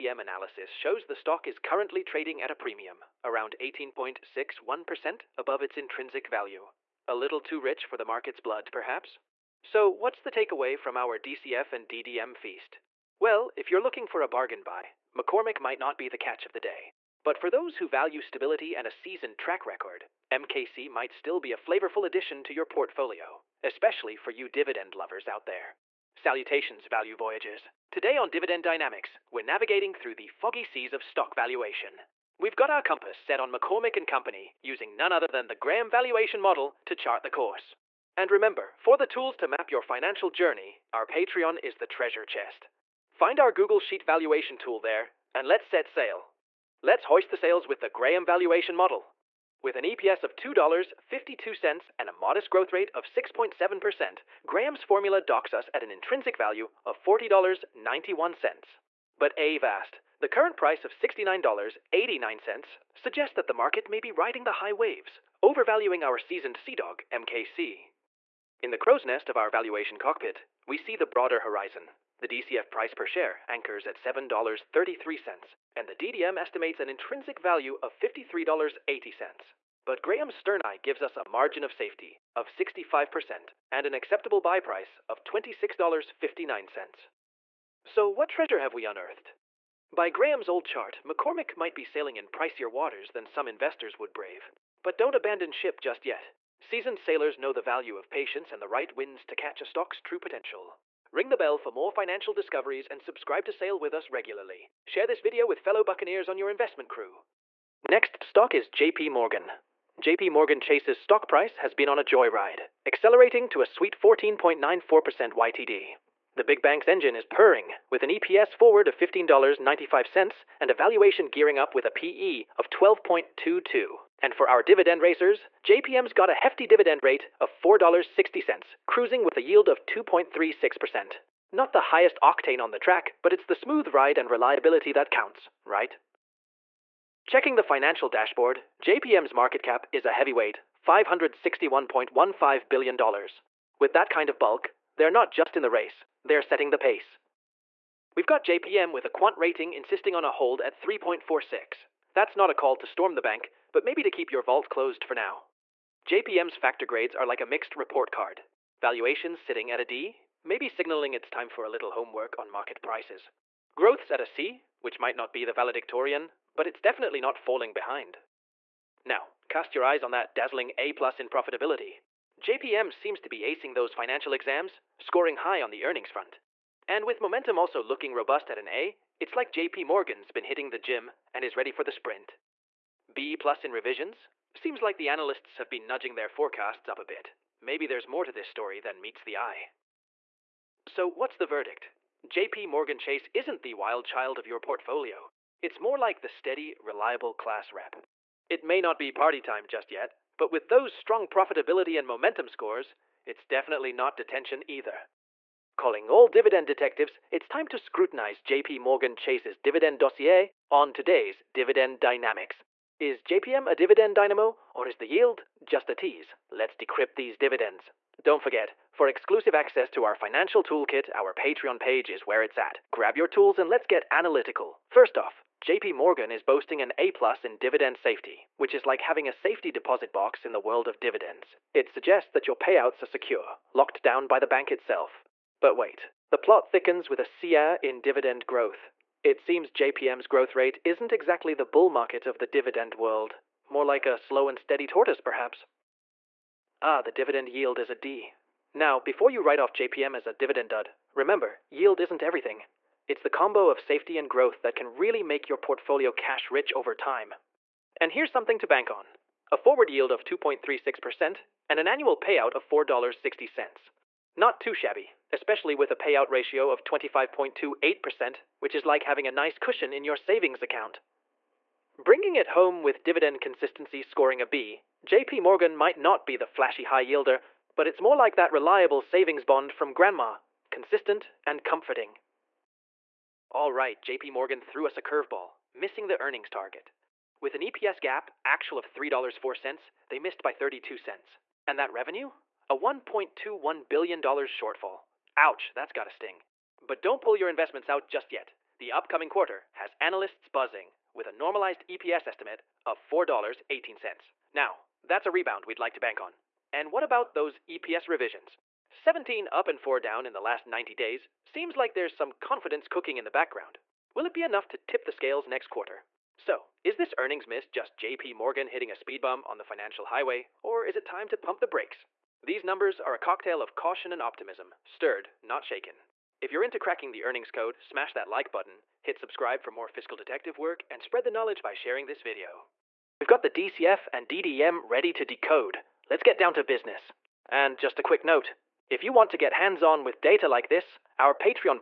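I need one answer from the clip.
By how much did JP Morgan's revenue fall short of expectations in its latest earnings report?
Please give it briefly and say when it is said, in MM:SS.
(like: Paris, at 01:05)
$1.21 billion, at 04:52.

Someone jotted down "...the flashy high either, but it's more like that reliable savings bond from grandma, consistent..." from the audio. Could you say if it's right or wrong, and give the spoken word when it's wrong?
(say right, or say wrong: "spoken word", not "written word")
wrong: "yielder", not "either".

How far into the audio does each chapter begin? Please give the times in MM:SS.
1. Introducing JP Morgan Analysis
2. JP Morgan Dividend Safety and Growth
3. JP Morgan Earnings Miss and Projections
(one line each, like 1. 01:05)
1. 00:46
2. 02:32
3. 04:06.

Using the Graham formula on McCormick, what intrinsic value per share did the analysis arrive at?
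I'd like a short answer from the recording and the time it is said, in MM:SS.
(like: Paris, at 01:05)
$40.91, at 00:57.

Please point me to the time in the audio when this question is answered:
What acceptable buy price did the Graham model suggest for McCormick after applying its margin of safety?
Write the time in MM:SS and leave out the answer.
01:25.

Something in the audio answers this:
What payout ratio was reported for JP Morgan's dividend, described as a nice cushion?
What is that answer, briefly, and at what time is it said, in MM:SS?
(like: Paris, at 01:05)
25.28%, at 04:26.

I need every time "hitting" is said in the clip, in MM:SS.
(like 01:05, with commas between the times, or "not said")
03:00, 05:18.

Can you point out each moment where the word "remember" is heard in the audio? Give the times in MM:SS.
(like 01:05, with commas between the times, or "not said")
00:38, 04:11.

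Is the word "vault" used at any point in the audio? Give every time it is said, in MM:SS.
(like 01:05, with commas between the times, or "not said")
02:34.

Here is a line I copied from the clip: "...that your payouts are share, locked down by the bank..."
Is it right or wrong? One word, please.
wrong.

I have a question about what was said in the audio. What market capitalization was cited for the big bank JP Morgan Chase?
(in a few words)
$561.15 billion.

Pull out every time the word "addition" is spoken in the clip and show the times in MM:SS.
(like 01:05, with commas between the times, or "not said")
00:22.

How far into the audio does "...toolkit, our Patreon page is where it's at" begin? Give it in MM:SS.
03:40.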